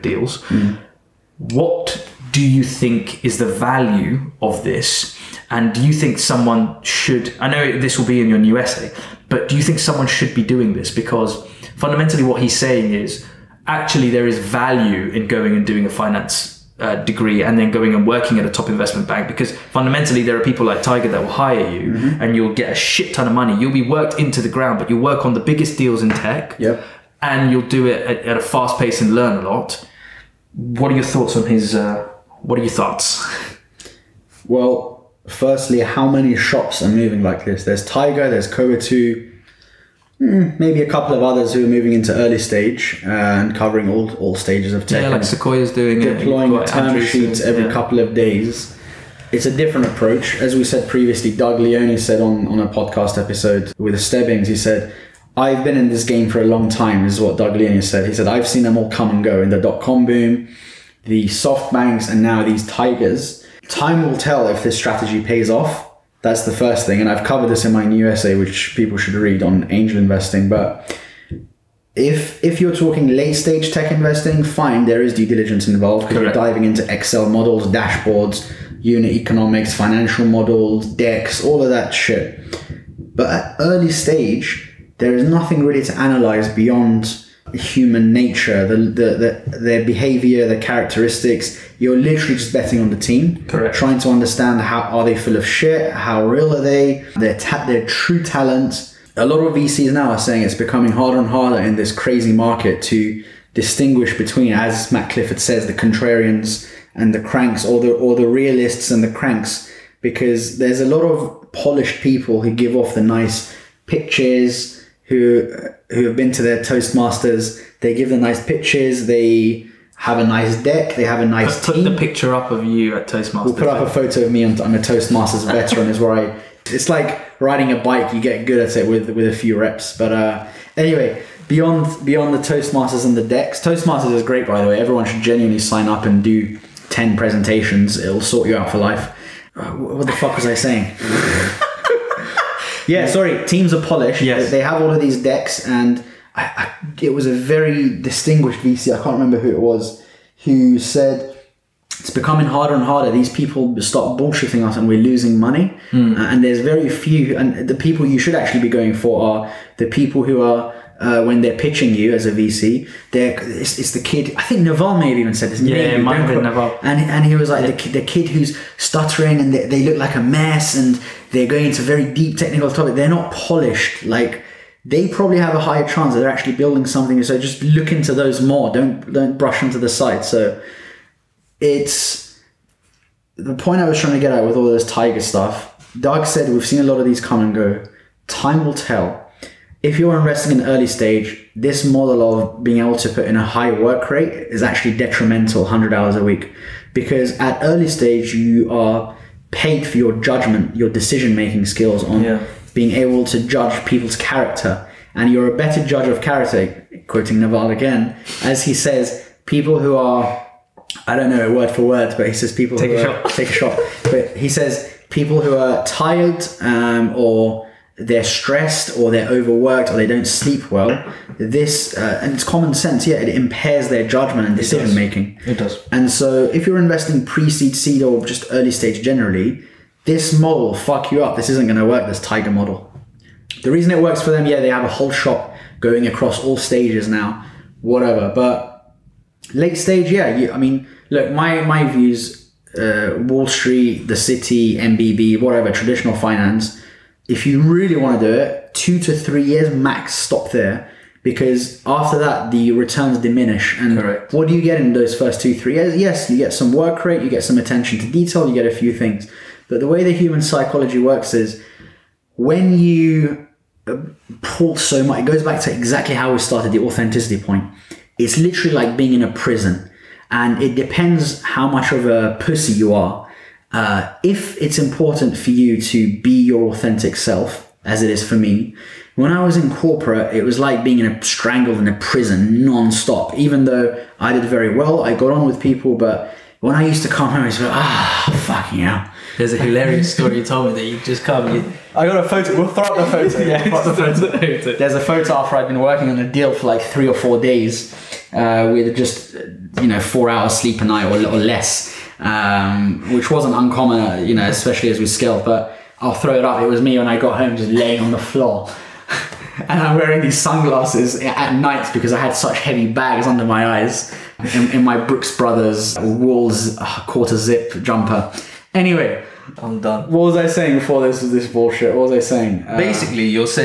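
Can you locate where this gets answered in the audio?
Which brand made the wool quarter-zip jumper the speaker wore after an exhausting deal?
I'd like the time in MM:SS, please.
05:14.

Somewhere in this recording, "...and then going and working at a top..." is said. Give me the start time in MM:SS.
00:17.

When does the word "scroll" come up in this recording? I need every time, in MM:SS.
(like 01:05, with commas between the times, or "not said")
not said.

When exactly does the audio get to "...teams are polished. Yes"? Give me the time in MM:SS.
02:23.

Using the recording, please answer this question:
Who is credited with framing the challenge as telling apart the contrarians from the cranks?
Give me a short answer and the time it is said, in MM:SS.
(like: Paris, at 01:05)
Matt Clifford, at 01:44.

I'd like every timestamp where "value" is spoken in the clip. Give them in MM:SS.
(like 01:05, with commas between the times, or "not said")
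00:03, 00:14.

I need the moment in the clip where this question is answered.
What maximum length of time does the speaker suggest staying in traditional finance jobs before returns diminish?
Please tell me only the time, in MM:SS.
04:08.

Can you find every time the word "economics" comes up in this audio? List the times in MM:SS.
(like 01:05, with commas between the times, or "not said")
01:19.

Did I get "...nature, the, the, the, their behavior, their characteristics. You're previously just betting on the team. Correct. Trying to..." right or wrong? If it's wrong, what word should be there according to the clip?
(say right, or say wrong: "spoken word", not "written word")
wrong: "literally", not "previously".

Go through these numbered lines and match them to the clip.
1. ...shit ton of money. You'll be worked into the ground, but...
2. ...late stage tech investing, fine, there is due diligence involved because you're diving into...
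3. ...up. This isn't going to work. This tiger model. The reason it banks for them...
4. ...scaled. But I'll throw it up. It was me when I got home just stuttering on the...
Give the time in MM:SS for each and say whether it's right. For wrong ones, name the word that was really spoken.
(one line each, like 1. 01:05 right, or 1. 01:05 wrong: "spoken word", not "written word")
1. 00:22 right
2. 01:13 right
3. 03:51 wrong: "works", not "banks"
4. 05:05 wrong: "laying", not "stuttering".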